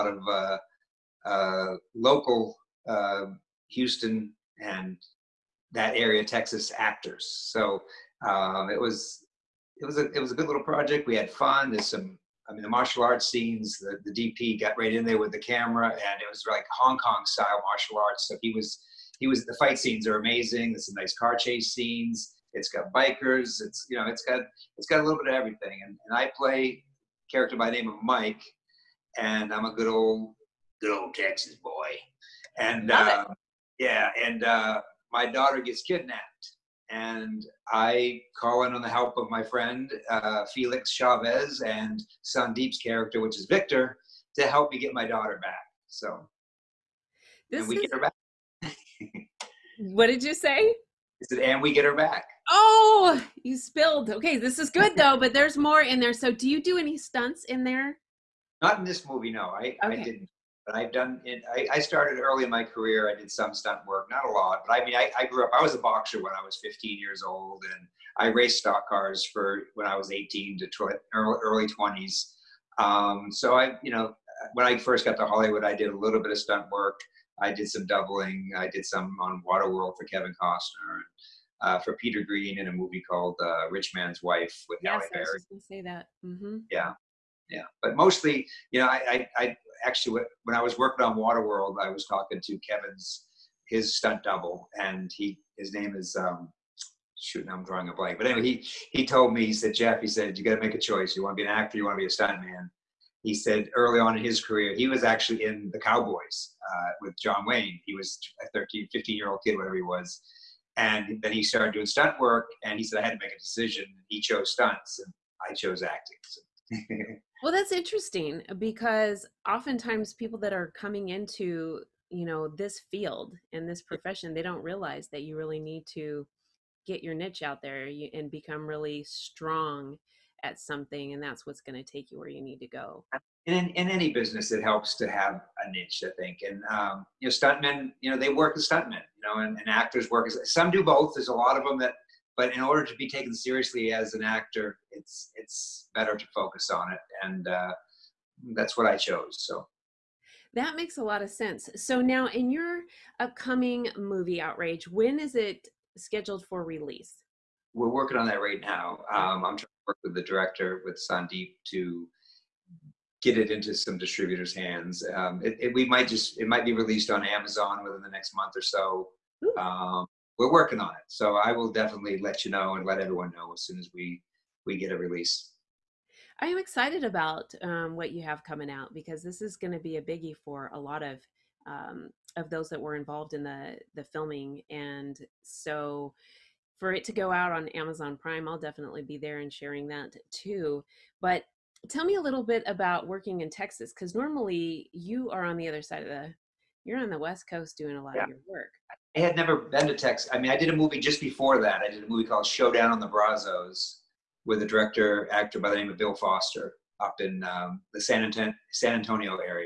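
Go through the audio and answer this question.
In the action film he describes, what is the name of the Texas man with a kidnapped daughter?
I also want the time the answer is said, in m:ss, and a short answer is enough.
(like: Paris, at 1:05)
Mike, at 0:28.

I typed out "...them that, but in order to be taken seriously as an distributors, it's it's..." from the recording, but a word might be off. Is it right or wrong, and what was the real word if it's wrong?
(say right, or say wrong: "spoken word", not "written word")
wrong: "actor", not "distributors".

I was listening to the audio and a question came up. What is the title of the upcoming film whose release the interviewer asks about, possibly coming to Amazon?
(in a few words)
Outrage.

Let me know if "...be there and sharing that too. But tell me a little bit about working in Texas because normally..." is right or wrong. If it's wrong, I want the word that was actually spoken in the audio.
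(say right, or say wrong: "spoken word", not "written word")
right.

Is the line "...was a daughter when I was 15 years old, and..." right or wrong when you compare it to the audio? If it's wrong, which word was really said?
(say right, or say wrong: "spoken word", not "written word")
wrong: "boxer", not "daughter".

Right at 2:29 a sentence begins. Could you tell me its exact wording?
So that makes a lot of sense.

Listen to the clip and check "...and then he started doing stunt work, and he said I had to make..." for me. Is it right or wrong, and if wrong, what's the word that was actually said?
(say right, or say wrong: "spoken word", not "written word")
right.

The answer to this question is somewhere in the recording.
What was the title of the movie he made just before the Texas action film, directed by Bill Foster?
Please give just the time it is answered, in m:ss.
3:22.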